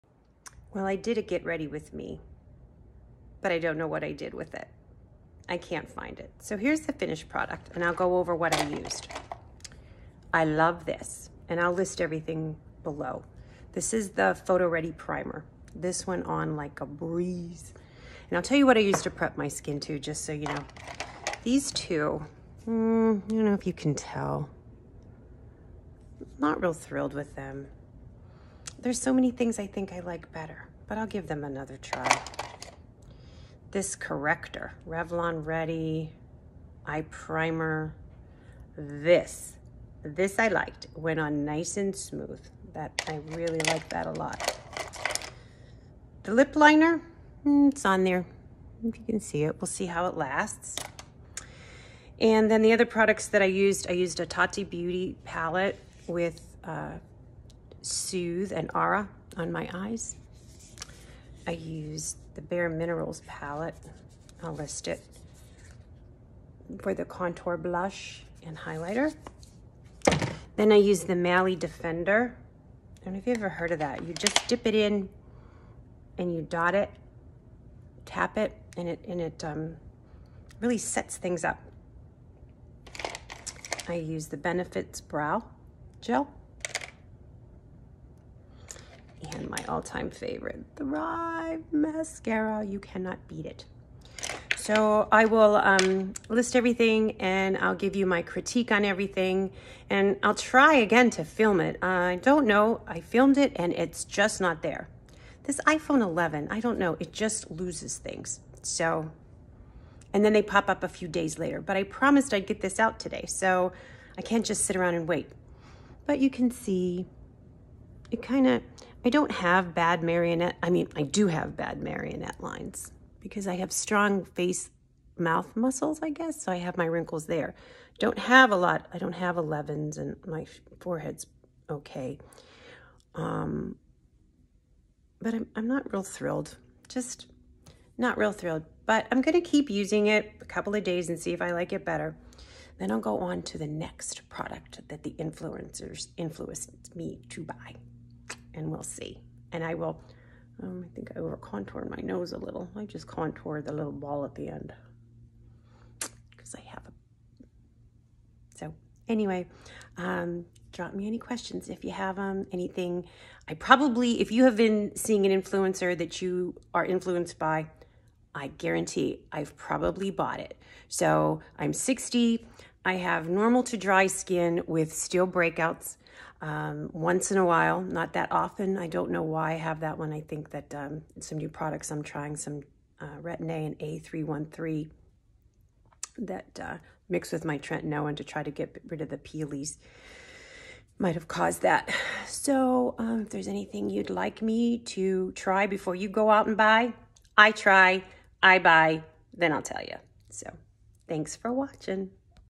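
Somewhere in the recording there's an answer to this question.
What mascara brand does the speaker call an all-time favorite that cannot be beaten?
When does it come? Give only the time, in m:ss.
1:30.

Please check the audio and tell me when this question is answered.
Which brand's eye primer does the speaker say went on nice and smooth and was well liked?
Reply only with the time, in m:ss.
0:34.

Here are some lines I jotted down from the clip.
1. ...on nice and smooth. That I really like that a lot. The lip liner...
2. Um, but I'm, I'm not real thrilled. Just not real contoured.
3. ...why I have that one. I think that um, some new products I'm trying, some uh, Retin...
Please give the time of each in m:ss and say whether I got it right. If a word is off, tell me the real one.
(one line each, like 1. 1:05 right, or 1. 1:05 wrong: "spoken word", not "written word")
1. 0:41 right
2. 2:13 wrong: "thrilled", not "contoured"
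3. 2:59 right.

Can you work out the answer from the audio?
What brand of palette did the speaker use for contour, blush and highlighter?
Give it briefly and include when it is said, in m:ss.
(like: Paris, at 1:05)
Bare Minerals, at 1:02.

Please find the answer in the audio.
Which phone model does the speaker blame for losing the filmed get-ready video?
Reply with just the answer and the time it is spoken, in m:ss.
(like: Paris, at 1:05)
iPhone 11, at 1:45.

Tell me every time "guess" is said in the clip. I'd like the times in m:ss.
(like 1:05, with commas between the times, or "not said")
2:06.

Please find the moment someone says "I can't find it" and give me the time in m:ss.
0:05.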